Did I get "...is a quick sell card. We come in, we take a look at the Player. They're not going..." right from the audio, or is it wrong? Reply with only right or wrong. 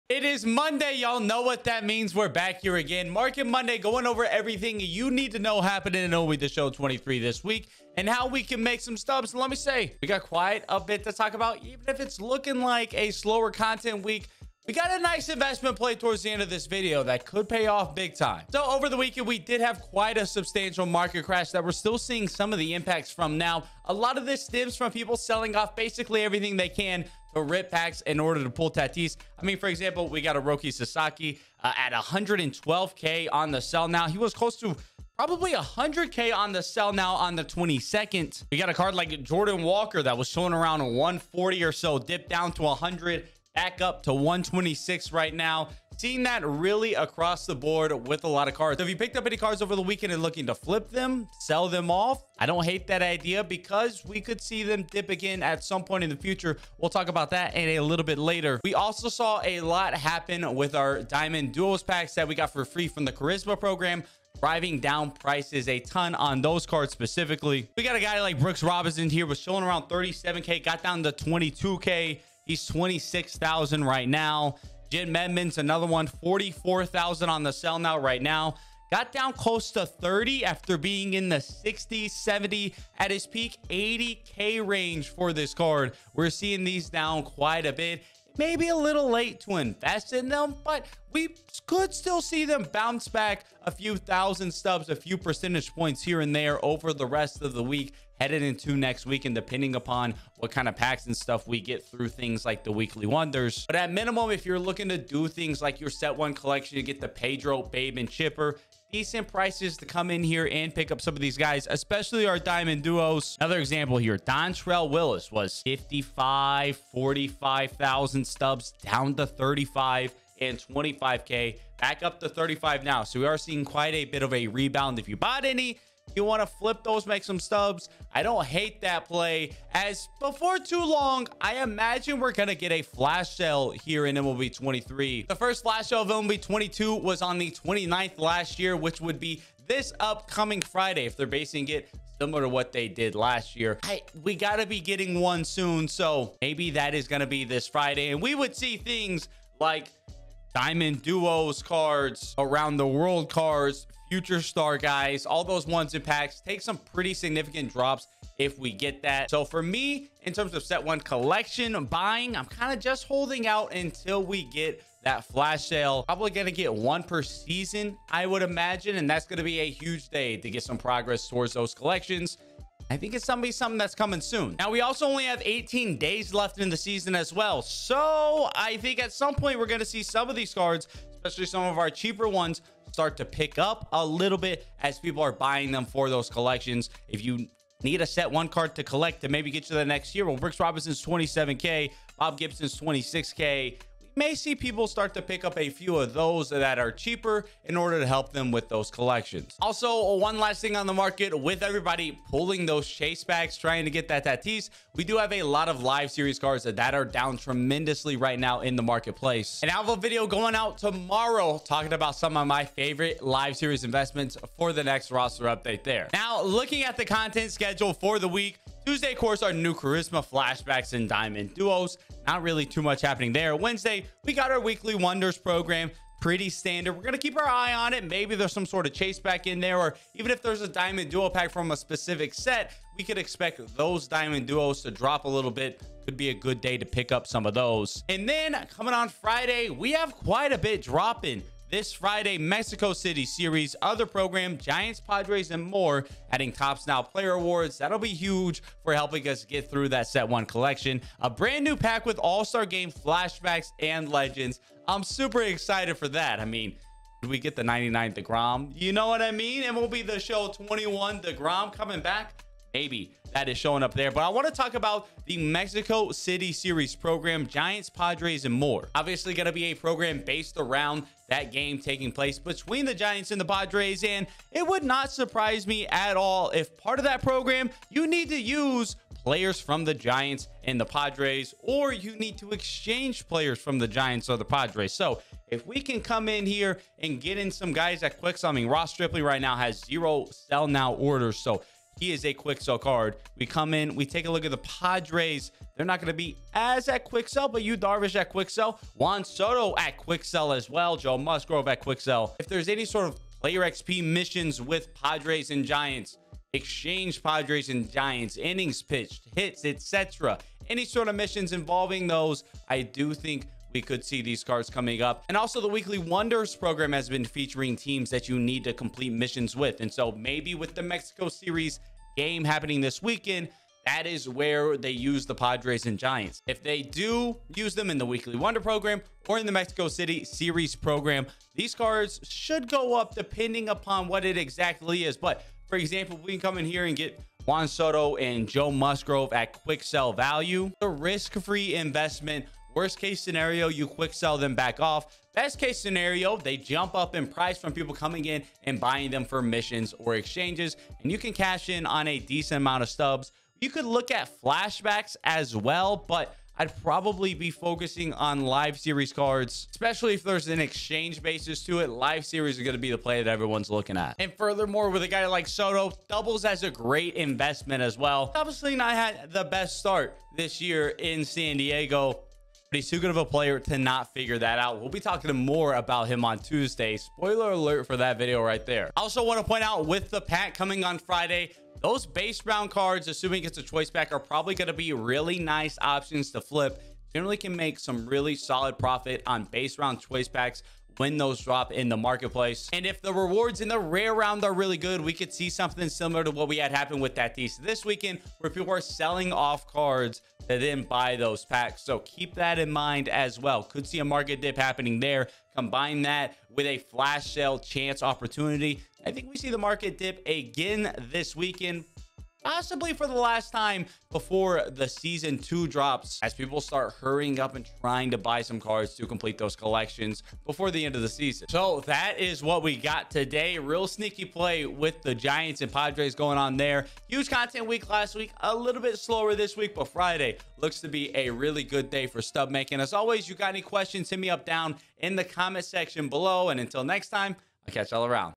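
wrong.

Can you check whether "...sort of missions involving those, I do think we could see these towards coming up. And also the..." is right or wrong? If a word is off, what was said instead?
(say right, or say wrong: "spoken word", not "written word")
wrong: "cards", not "towards".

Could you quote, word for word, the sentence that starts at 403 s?
Could see a market dip happening there.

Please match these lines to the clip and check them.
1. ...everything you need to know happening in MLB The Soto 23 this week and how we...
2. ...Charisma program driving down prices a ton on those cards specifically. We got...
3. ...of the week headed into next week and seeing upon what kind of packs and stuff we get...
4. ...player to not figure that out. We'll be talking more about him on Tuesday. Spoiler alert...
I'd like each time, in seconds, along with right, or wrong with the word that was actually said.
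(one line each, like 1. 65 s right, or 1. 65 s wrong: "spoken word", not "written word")
1. 4 s wrong: "Show", not "Soto"
2. 63 s right
3. 97 s wrong: "depending", not "seeing"
4. 373 s right.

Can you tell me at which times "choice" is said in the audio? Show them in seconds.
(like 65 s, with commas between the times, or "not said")
383 s, 389 s.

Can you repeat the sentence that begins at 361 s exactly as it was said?
Live series are going to be the play that everyone's looking at.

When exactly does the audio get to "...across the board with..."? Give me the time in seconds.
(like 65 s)
46 s.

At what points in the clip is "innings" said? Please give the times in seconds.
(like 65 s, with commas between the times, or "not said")
308 s.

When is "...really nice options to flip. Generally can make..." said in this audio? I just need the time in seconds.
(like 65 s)
384 s.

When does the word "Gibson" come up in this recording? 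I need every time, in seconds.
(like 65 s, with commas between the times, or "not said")
192 s.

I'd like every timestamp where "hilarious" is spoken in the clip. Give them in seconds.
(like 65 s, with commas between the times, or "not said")
not said.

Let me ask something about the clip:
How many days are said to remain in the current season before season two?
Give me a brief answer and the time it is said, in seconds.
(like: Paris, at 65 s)
18, at 175 s.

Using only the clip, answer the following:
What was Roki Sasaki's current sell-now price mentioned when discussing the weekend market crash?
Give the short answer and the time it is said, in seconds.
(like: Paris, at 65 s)
112K, at 31 s.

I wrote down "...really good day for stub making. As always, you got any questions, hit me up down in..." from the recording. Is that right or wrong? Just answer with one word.
right.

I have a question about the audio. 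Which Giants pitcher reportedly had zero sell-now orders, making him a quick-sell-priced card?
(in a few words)
Ross Stripling.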